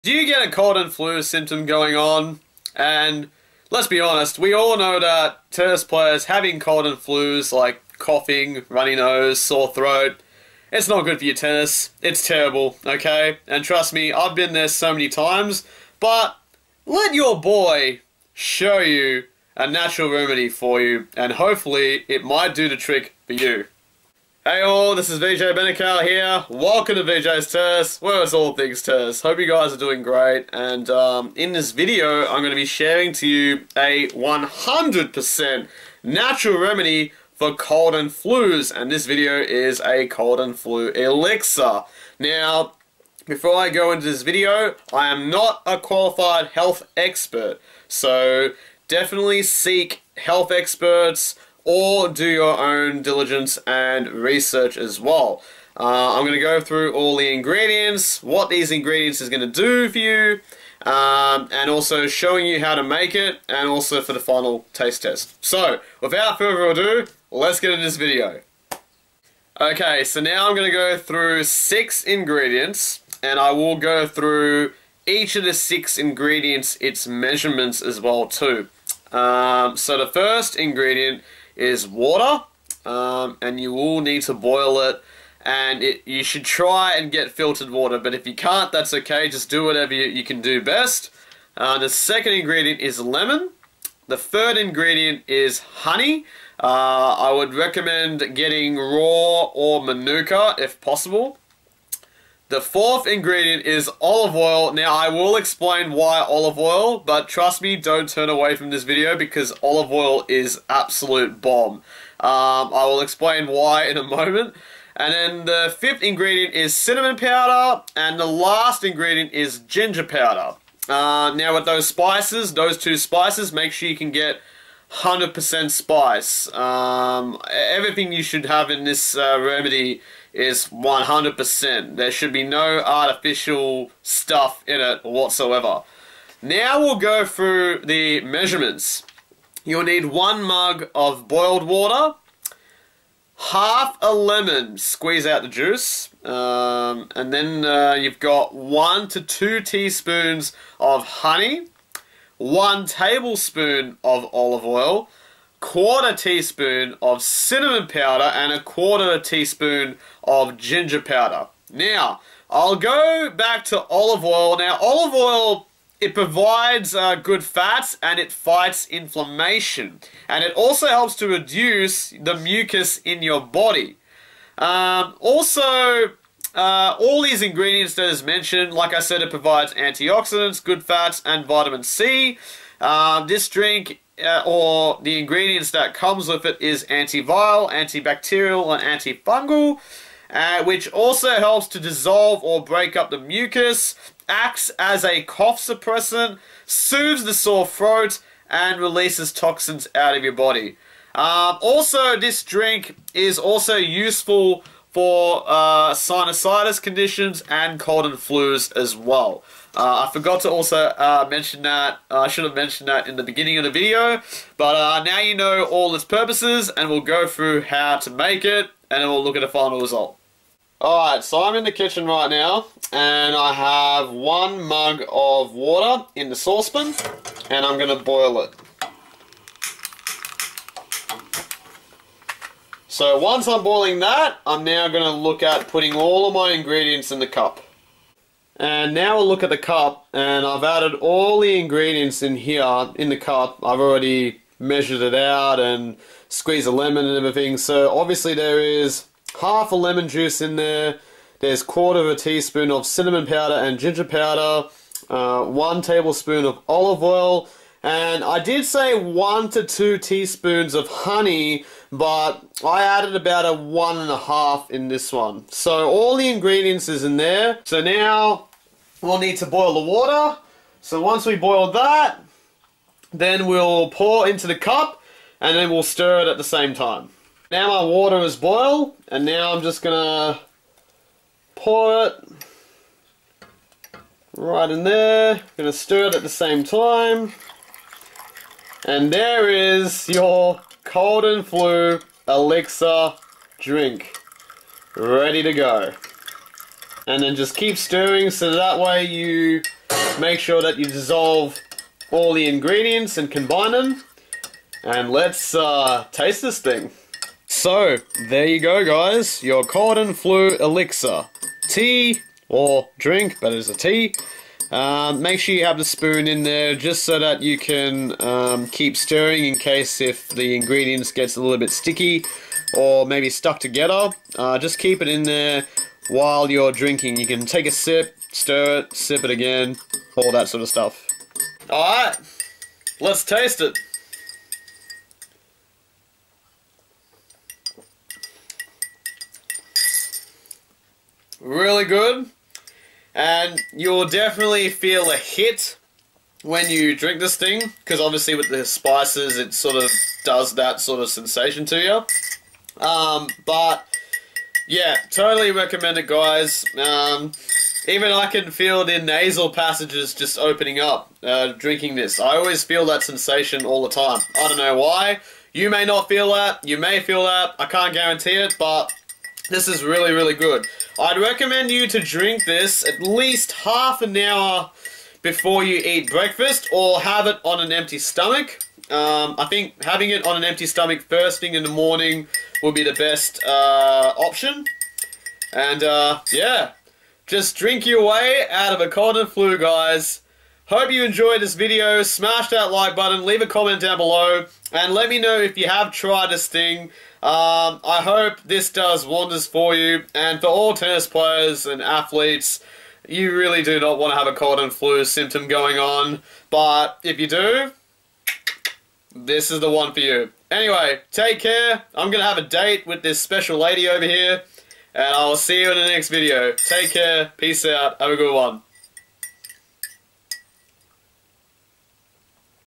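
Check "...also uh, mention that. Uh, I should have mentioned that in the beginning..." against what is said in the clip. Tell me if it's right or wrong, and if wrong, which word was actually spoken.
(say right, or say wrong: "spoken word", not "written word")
right.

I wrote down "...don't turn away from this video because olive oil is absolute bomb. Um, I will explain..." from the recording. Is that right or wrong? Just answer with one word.
right.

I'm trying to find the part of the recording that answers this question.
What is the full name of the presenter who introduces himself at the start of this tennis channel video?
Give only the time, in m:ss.
0:25.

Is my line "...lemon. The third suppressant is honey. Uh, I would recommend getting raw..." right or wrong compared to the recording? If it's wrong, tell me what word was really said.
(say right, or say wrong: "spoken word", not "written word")
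wrong: "ingredient", not "suppressant".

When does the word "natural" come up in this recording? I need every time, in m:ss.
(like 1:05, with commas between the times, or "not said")
0:19, 0:36.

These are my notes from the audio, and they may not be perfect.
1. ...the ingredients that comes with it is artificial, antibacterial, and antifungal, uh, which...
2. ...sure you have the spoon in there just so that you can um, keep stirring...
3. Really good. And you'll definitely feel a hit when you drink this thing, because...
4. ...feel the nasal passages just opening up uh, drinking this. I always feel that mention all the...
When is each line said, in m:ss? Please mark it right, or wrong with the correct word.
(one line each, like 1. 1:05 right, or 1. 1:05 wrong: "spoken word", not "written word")
1. 3:05 wrong: "antiviral", not "artificial"
2. 5:15 right
3. 5:41 right
4. 5:58 wrong: "sensation", not "mention".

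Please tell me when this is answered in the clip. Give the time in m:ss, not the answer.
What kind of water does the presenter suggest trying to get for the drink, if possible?
1:27.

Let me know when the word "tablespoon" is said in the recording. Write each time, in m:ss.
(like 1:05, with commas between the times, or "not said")
2:32, 4:15.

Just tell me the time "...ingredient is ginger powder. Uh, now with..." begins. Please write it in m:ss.
1:58.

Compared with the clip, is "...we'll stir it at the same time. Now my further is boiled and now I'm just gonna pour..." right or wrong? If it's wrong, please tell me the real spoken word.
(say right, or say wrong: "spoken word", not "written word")
wrong: "water", not "further".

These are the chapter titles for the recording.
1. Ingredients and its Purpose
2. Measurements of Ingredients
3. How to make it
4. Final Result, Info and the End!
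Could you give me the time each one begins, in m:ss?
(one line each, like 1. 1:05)
1. 1:09
2. 2:18
3. 3:40
4. 5:08.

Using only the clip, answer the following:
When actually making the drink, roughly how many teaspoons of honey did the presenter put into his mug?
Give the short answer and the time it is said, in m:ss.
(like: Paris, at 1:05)
1.5, at 4:23.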